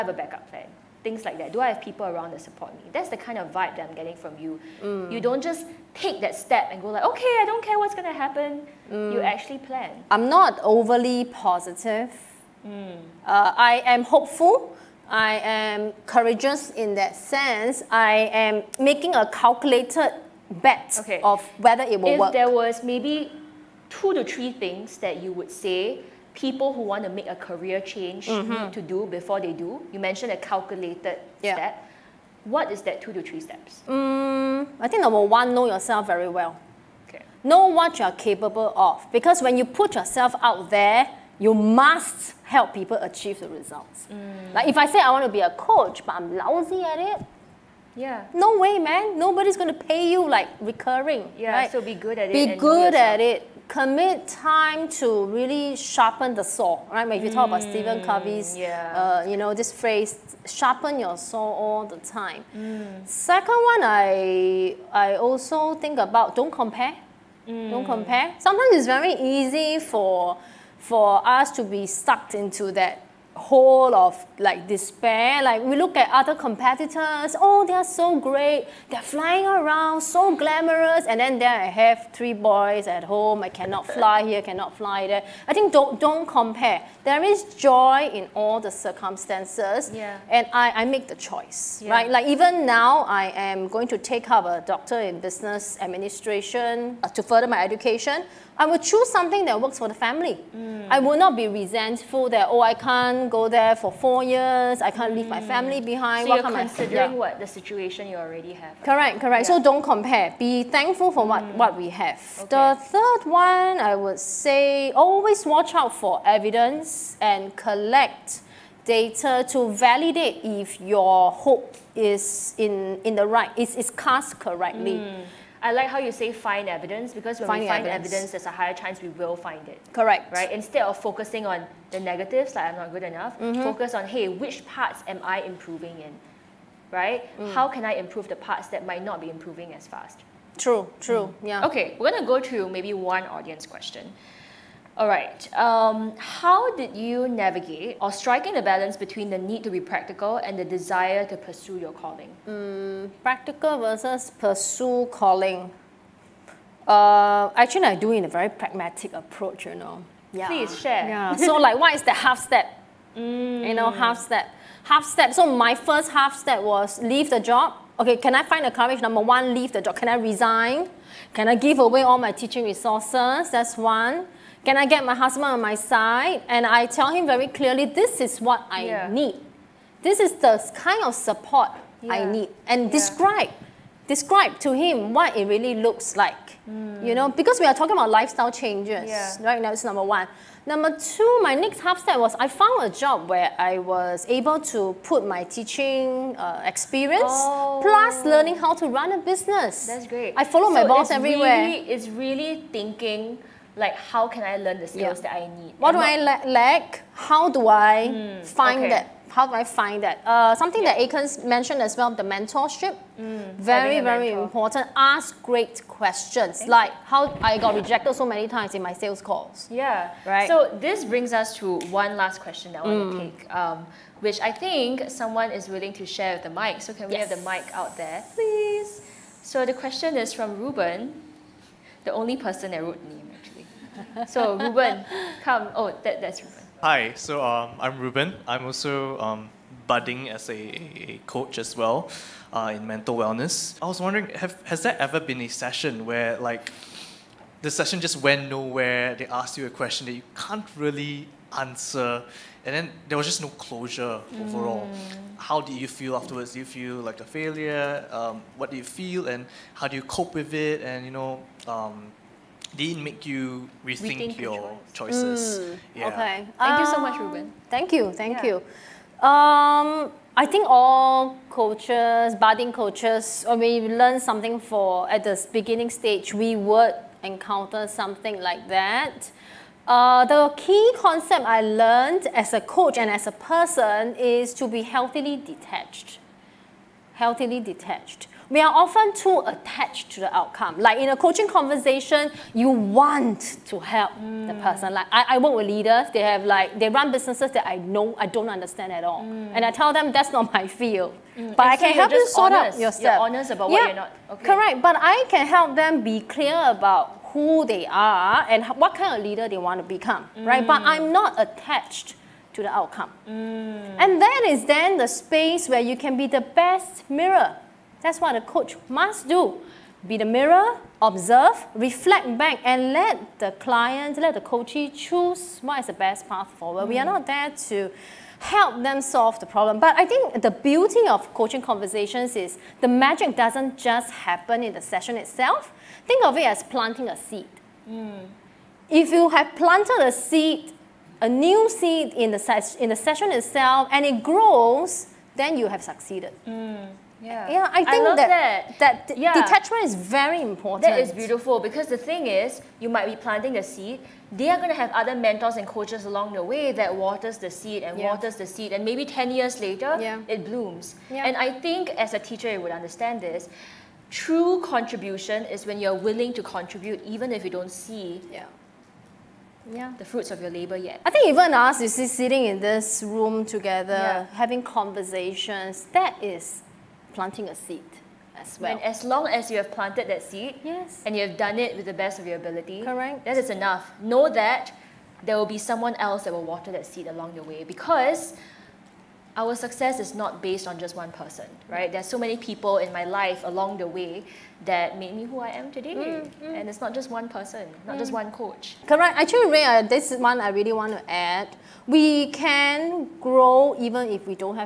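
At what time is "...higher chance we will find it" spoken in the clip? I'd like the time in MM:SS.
02:08.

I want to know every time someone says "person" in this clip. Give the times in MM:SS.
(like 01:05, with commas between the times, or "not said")
03:52, 04:43, 04:54, 06:31, 06:37.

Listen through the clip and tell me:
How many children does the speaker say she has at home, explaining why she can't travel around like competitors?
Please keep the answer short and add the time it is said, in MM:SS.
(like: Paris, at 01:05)
3, at 01:22.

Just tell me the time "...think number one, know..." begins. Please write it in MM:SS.
00:34.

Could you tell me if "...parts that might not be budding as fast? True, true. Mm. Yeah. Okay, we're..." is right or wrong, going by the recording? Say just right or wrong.
wrong.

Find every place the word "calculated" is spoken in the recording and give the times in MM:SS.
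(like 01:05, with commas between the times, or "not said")
00:19, 00:30.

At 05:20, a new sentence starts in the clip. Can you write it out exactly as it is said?
Be the mirror, observe, reflect back, and let the client, let the coachee choose what is the best path forward.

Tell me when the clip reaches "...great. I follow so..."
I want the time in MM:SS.
03:20.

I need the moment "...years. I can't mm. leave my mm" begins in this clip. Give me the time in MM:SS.
01:44.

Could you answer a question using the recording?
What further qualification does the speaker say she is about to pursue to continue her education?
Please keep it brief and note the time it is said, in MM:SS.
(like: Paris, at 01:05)
Doctor in Business Administration, at 01:34.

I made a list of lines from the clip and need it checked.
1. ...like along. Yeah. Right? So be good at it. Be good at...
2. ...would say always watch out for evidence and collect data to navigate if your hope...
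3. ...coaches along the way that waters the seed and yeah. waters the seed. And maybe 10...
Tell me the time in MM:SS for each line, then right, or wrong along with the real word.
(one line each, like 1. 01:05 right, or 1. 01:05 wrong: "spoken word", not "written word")
1. 00:50 wrong: "recurring", not "along"
2. 01:53 wrong: "validate", not "navigate"
3. 05:55 right.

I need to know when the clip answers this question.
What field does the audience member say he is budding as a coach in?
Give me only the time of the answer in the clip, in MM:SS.
04:02.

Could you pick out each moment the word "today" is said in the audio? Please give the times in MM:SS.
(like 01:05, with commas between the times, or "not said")
06:35.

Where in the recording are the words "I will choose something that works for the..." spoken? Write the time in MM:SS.
01:38.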